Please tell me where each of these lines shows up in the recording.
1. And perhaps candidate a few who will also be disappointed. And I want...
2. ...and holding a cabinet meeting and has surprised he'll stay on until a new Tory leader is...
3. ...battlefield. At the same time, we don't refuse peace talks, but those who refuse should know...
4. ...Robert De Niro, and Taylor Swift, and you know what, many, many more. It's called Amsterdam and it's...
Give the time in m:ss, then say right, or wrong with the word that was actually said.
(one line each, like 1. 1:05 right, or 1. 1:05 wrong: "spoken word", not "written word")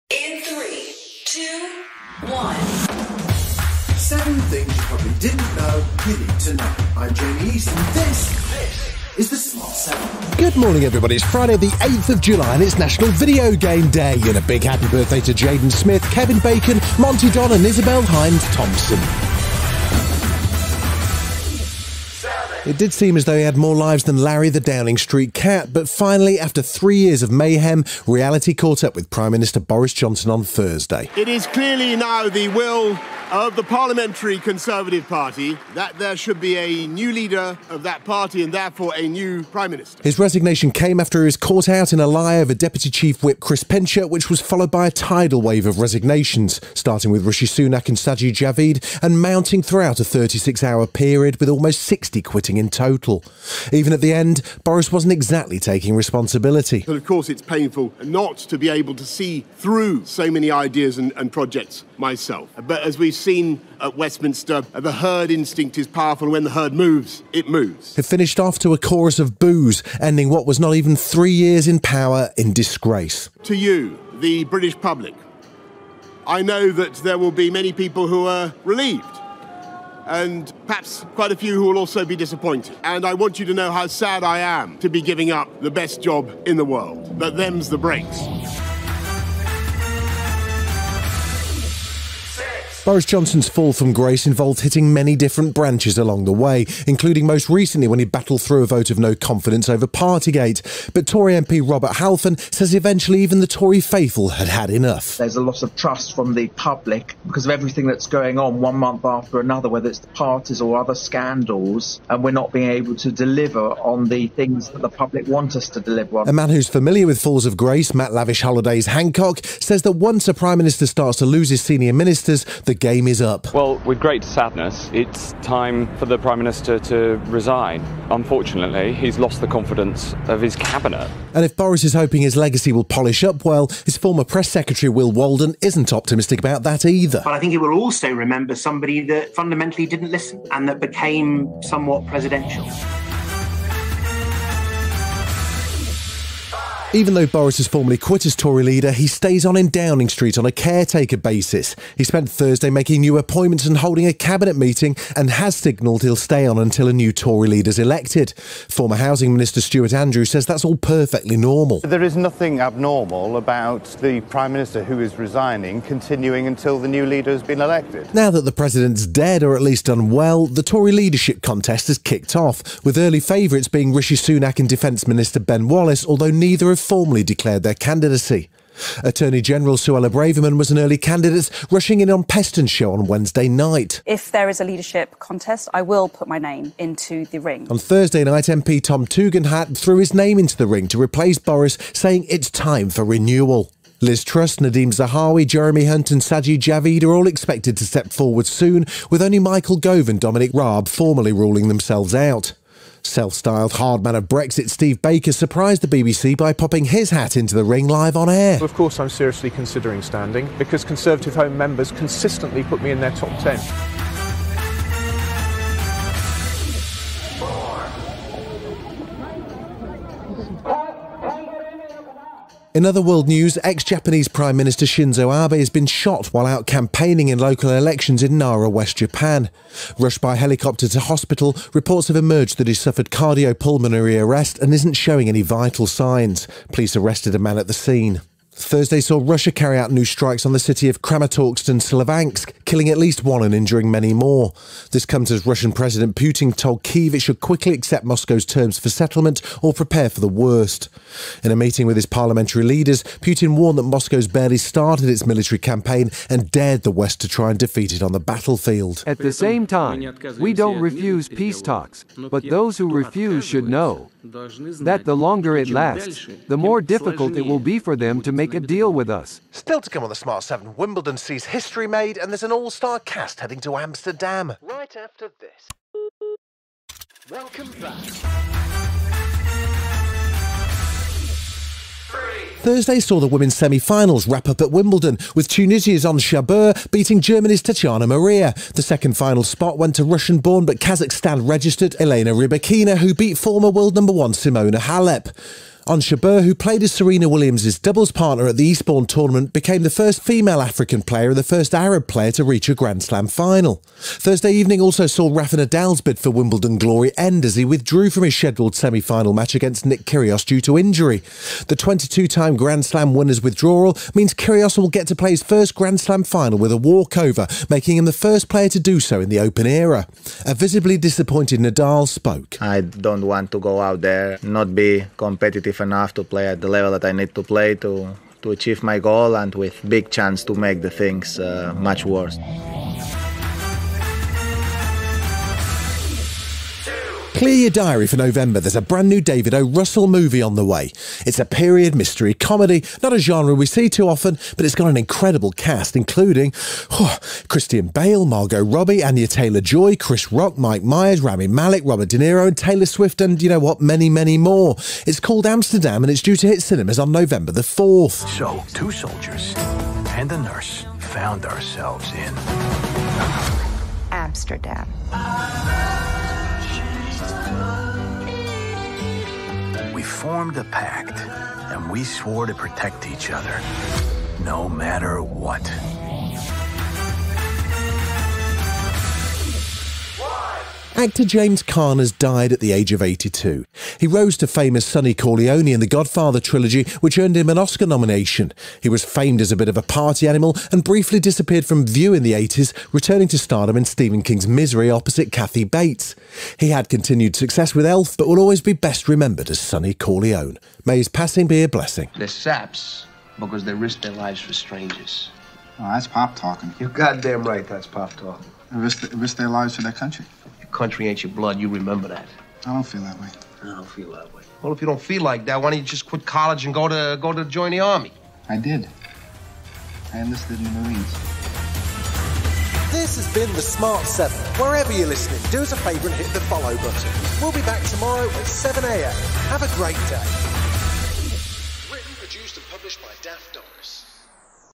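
1. 1:20 wrong: "quite", not "candidate"
2. 2:33 wrong: "signalled", not "surprised"
3. 4:18 right
4. 5:51 right.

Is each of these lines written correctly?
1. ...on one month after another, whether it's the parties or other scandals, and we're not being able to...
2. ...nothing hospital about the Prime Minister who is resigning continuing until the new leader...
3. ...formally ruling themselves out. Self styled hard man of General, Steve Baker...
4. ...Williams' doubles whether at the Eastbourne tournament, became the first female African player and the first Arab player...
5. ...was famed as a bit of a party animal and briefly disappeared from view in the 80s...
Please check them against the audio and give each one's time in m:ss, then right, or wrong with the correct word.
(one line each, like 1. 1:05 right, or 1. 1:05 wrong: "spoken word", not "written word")
1. 1:48 right
2. 2:42 wrong: "abnormal", not "hospital"
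3. 3:20 wrong: "Brexit", not "General"
4. 4:57 wrong: "partner", not "whether"
5. 6:28 right.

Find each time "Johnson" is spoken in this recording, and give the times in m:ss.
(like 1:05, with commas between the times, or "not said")
0:29, 1:33.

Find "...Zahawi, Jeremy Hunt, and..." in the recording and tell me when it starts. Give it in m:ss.
3:14.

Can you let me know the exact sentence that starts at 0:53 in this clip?
Even at the end, Boris wasn't exactly taking responsibility.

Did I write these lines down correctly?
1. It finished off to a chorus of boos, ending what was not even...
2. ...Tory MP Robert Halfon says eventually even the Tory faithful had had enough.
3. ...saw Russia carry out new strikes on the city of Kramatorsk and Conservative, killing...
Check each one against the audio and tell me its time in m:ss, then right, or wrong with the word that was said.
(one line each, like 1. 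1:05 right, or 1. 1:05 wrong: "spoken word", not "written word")
1. 1:07 right
2. 1:41 right
3. 3:59 wrong: "Sloviansk", not "Conservative".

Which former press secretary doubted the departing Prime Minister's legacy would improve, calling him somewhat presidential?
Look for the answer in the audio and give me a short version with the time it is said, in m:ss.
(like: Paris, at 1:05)
Will Walden, at 2:14.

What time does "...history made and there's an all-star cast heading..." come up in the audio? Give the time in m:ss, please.
4:31.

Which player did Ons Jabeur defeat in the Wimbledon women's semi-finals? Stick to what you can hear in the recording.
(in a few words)
Tatiana Maria.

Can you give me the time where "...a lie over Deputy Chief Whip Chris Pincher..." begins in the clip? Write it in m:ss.
0:42.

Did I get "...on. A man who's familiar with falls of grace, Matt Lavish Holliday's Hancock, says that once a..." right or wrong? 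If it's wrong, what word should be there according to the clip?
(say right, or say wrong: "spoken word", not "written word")
right.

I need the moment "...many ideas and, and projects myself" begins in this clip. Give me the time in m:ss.
1:00.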